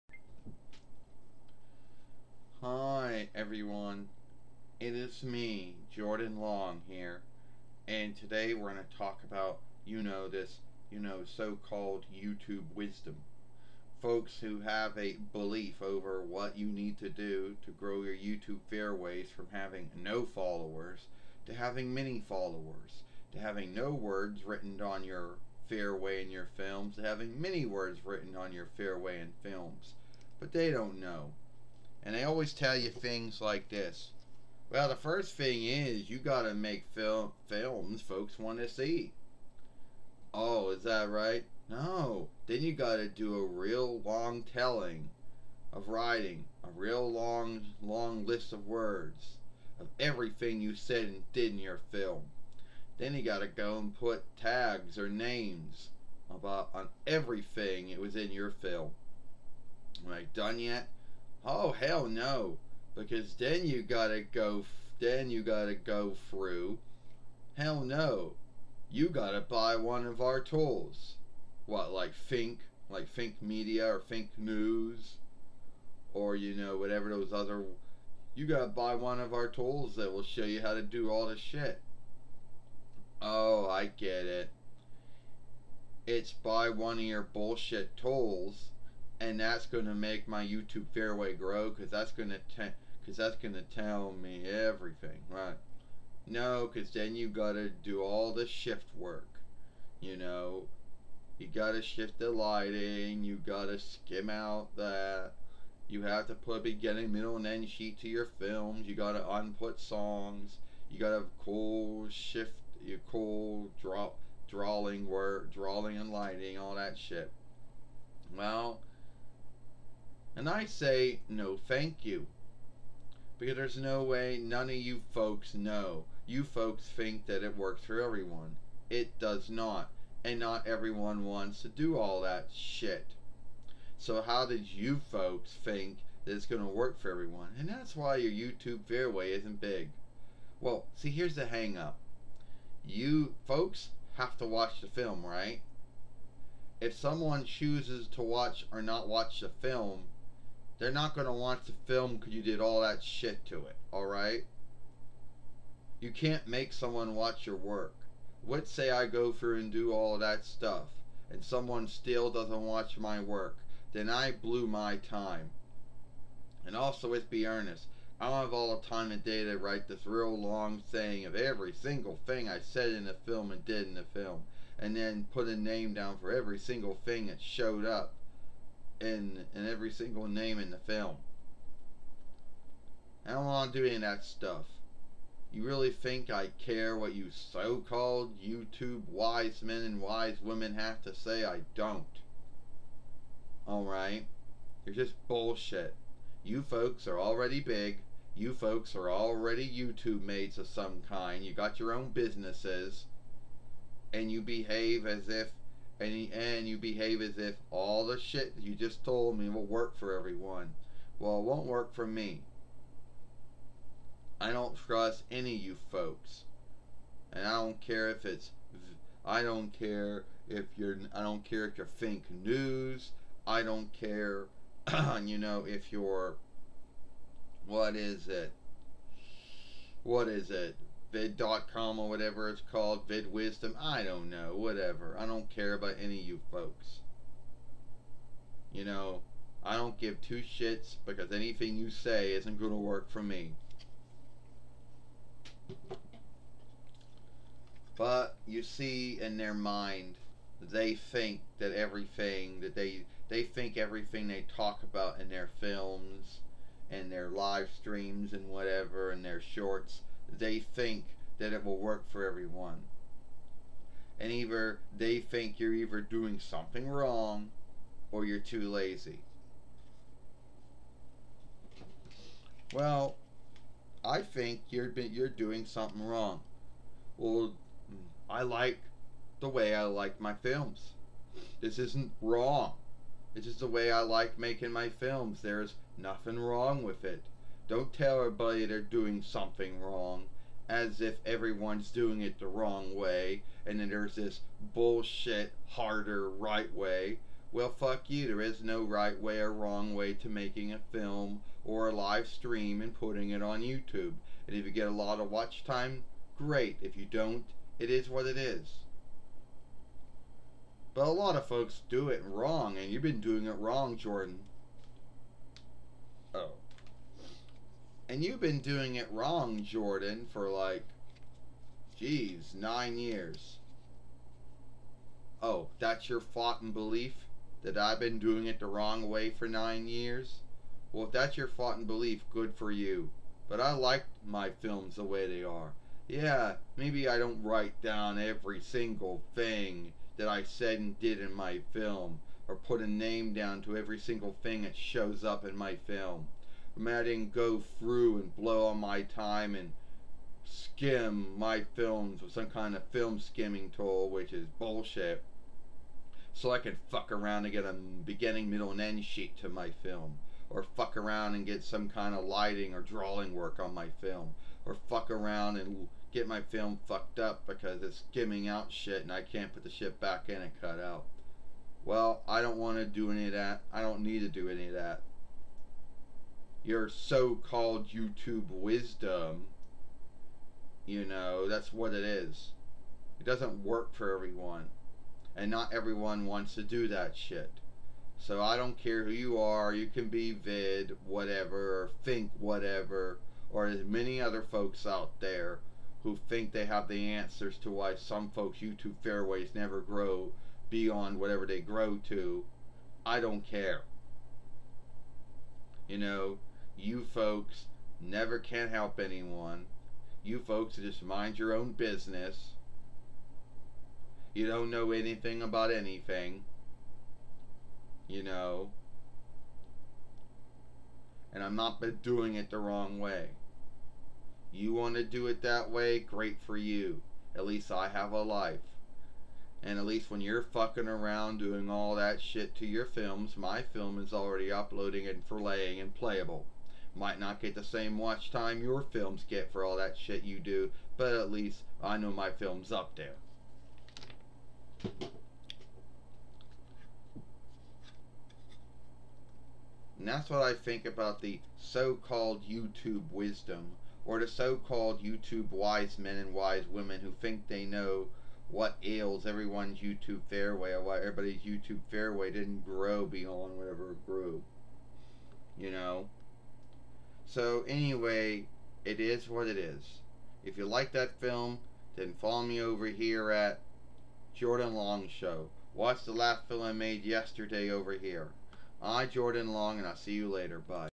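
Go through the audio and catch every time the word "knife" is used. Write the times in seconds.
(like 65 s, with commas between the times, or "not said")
not said.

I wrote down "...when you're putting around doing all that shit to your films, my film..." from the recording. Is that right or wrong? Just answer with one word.
wrong.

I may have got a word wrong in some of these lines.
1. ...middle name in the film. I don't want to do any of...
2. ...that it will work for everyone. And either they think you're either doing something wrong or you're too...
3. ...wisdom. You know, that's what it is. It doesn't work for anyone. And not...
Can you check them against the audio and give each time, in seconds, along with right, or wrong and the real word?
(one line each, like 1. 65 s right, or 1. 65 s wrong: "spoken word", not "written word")
1. 179 s wrong: "single", not "middle"
2. 261 s right
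3. 378 s wrong: "everyone", not "anyone".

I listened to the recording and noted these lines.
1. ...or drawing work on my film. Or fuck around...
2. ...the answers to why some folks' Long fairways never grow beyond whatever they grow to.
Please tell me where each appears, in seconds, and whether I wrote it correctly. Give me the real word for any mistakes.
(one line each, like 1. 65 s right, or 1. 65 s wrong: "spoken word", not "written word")
1. 362 s right
2. 396 s wrong: "YouTube", not "Long".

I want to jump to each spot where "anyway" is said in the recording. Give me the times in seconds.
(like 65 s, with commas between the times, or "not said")
467 s.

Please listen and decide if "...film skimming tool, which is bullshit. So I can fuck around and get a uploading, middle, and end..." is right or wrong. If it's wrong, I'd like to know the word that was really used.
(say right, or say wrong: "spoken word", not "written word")
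wrong: "beginning", not "uploading".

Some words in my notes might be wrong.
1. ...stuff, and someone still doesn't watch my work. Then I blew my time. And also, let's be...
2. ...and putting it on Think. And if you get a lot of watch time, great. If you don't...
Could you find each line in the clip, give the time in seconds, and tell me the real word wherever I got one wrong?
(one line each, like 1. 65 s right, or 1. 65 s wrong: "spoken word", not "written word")
1. 160 s right
2. 302 s wrong: "YouTube", not "Think".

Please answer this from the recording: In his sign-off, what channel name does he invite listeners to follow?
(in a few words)
Jordan Long Show.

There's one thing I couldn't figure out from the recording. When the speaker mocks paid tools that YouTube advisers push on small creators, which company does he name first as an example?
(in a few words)
Think Media.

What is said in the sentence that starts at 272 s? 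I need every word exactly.
Well, I think you're you're doing something wrong.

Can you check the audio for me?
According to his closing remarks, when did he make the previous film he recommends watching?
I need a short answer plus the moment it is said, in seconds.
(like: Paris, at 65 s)
yesterday, at 477 s.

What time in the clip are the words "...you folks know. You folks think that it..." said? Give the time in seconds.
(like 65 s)
124 s.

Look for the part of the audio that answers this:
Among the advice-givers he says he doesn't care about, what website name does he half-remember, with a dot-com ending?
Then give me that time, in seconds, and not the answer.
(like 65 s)
231 s.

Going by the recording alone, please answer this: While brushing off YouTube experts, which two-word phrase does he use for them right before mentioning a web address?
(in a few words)
fake news.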